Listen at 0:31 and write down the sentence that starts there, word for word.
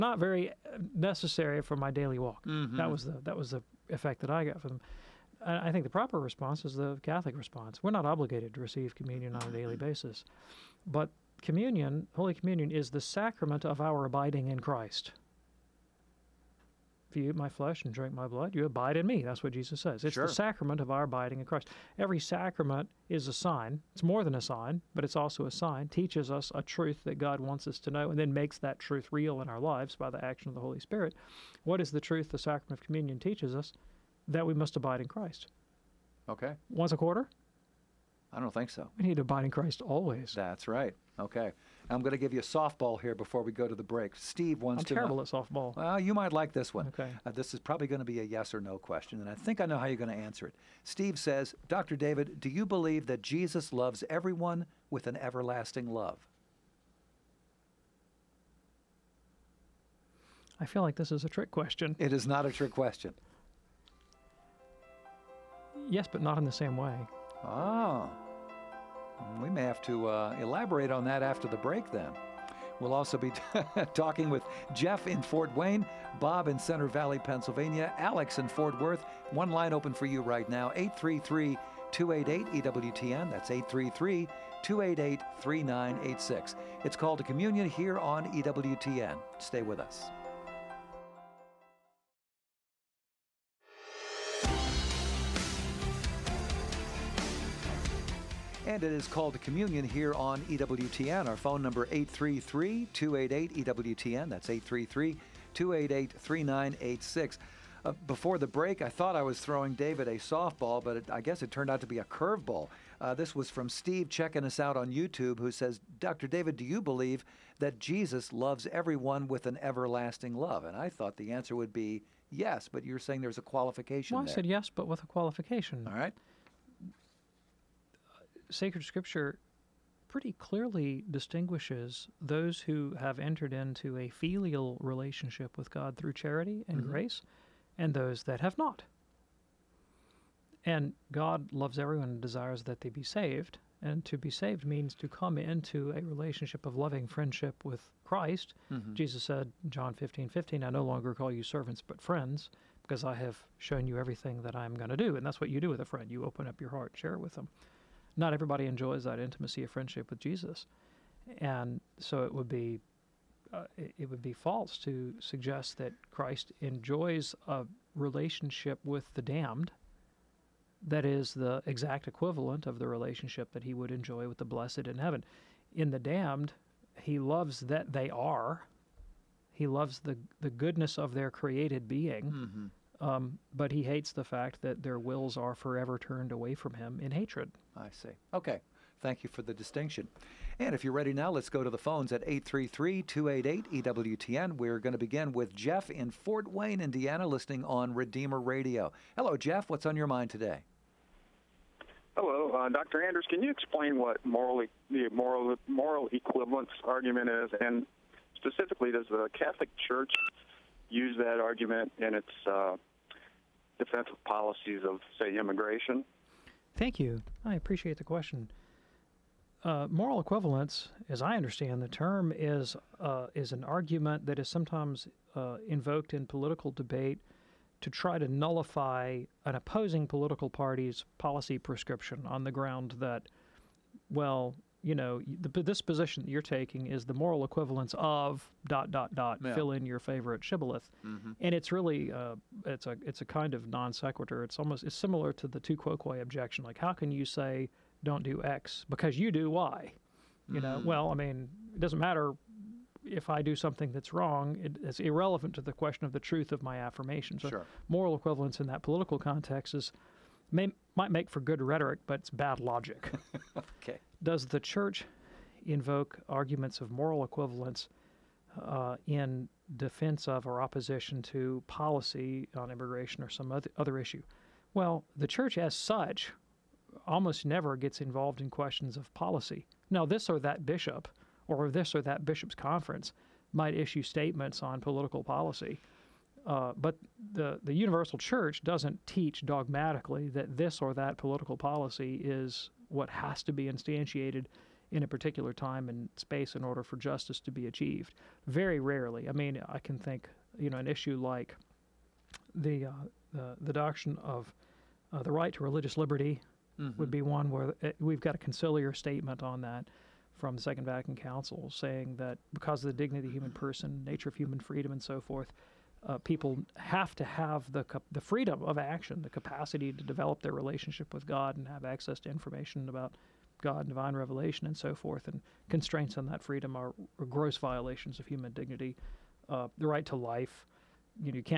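What is the truth the sacrament of communion teaches us?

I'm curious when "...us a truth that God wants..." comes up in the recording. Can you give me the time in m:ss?
0:26.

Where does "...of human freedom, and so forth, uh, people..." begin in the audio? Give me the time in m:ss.
5:14.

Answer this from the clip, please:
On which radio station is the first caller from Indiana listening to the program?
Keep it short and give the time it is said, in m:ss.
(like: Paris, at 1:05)
Redeemer Radio, at 3:17.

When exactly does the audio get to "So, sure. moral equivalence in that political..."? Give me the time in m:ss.
4:17.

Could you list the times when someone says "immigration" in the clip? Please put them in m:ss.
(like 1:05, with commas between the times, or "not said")
3:35, 4:32.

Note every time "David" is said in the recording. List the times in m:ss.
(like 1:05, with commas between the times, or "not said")
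0:51, 1:49, 1:56.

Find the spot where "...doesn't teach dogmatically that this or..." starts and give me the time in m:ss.
4:48.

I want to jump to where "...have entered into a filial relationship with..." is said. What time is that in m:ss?
2:12.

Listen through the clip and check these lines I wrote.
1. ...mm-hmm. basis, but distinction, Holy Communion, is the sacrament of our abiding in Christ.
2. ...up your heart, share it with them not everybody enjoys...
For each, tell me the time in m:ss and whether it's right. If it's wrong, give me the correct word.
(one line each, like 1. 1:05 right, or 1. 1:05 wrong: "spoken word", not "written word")
1. 0:09 wrong: "communion", not "distinction"
2. 2:36 right.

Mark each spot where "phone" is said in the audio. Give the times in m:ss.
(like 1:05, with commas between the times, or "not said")
1:41, 3:11.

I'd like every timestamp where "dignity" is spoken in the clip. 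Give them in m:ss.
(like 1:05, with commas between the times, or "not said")
5:12, 5:28.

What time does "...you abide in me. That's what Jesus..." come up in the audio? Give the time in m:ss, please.
0:18.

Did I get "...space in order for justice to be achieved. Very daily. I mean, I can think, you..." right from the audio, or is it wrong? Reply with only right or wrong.
wrong.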